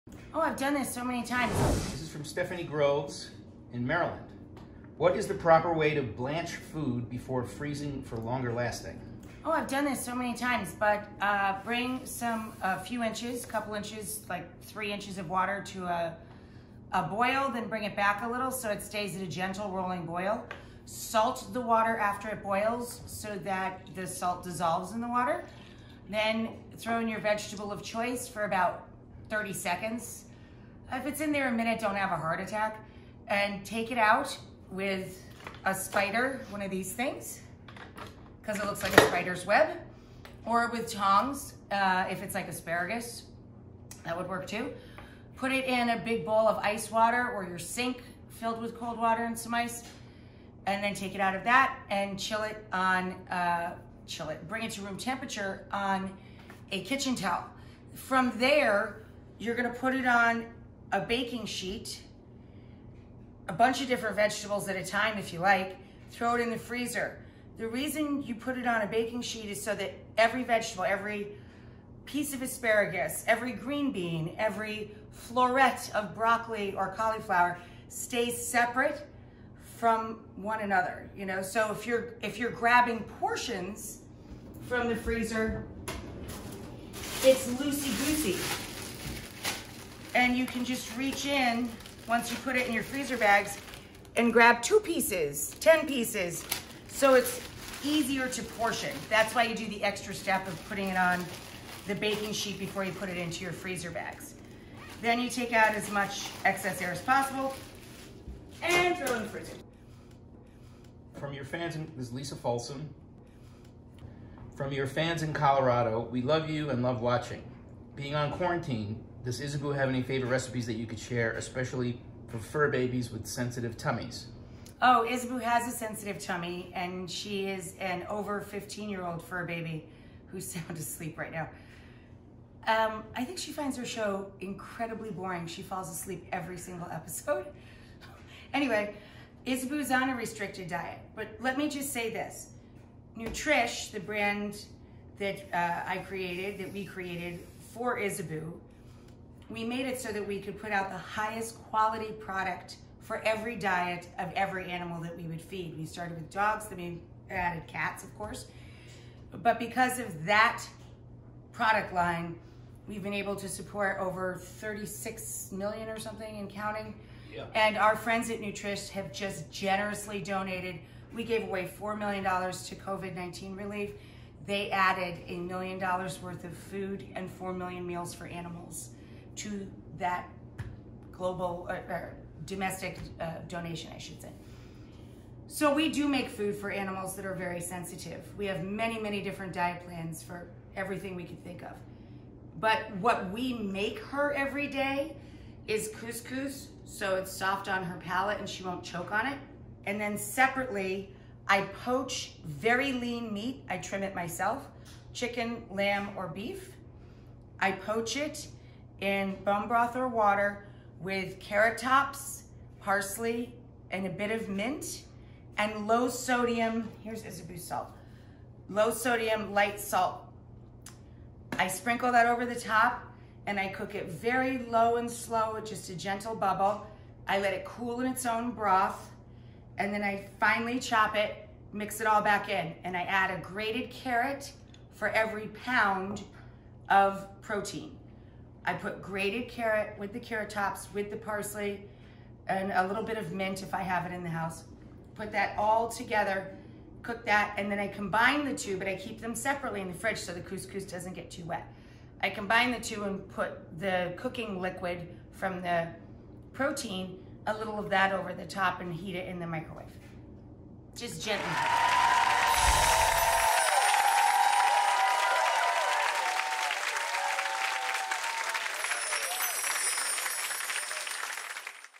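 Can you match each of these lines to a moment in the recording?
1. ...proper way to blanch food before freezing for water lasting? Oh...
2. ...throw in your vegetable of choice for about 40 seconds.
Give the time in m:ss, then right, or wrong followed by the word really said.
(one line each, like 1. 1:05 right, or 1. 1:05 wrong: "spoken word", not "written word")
1. 0:05 wrong: "longer", not "water"
2. 0:26 wrong: "30", not "40".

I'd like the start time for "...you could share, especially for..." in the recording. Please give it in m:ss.
2:00.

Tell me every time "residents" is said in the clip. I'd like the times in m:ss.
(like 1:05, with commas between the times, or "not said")
not said.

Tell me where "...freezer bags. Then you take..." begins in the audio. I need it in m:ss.
1:43.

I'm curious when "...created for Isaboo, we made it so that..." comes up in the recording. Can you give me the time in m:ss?
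2:26.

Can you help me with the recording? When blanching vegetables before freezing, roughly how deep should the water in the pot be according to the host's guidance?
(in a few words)
3 inches.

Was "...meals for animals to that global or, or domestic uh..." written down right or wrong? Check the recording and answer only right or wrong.
right.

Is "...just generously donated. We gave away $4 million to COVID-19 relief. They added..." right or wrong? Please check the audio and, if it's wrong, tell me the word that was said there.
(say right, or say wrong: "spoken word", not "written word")
right.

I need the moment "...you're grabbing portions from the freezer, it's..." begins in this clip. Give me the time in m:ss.
1:22.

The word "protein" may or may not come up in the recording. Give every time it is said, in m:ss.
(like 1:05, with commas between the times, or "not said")
3:57, 4:16.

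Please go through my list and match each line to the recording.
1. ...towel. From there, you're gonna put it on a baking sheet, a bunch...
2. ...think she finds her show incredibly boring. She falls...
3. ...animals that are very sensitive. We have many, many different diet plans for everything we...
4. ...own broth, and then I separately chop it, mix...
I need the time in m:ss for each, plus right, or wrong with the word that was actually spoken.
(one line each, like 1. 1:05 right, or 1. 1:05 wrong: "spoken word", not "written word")
1. 0:57 right
2. 2:13 right
3. 3:06 right
4. 3:48 wrong: "finely", not "separately".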